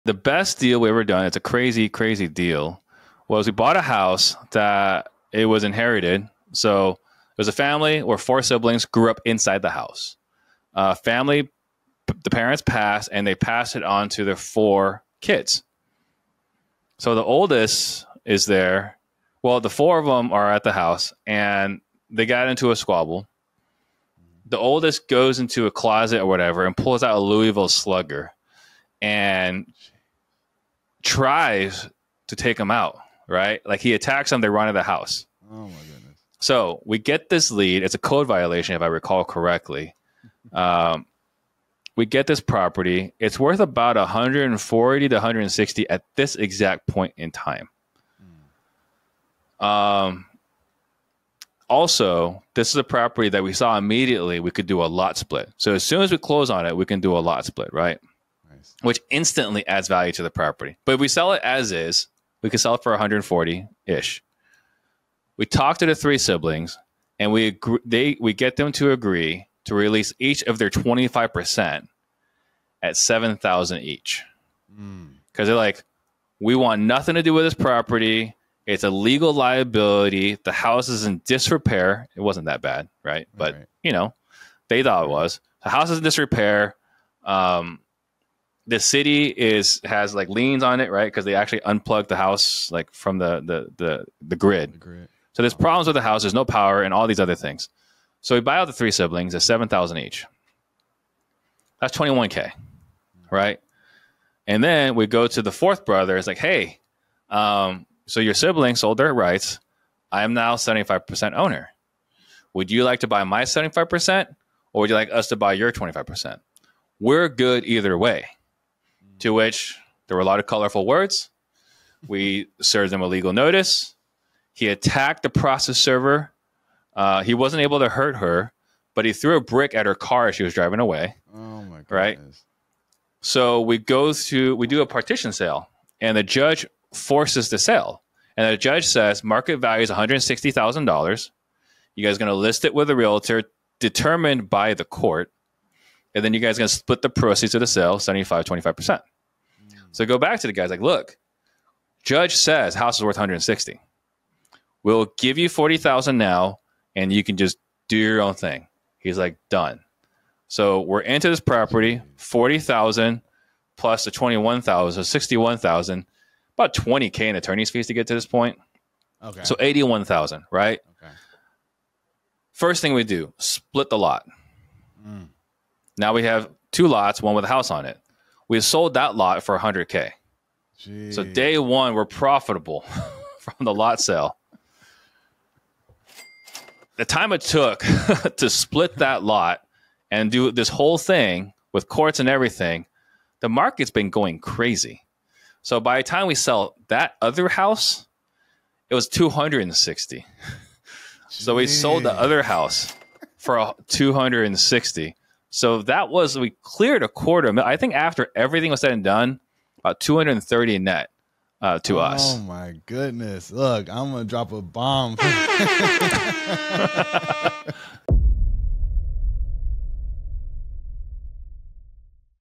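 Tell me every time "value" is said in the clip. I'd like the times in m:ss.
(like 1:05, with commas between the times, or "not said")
0:59, 2:19.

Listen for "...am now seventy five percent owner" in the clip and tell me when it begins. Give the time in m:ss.
1:50.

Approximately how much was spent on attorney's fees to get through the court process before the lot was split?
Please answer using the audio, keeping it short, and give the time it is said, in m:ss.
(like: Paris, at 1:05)
20K, at 2:46.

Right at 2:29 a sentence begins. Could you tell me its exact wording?
So go back to the guys like, look, judge says house is worth 160.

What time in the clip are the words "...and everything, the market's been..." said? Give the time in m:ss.
3:12.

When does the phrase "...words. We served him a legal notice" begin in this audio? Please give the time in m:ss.
2:00.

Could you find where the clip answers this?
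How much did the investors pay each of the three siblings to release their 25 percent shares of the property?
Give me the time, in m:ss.
1:12.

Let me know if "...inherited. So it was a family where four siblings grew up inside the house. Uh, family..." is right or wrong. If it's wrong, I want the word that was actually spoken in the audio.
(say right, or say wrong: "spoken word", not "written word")
right.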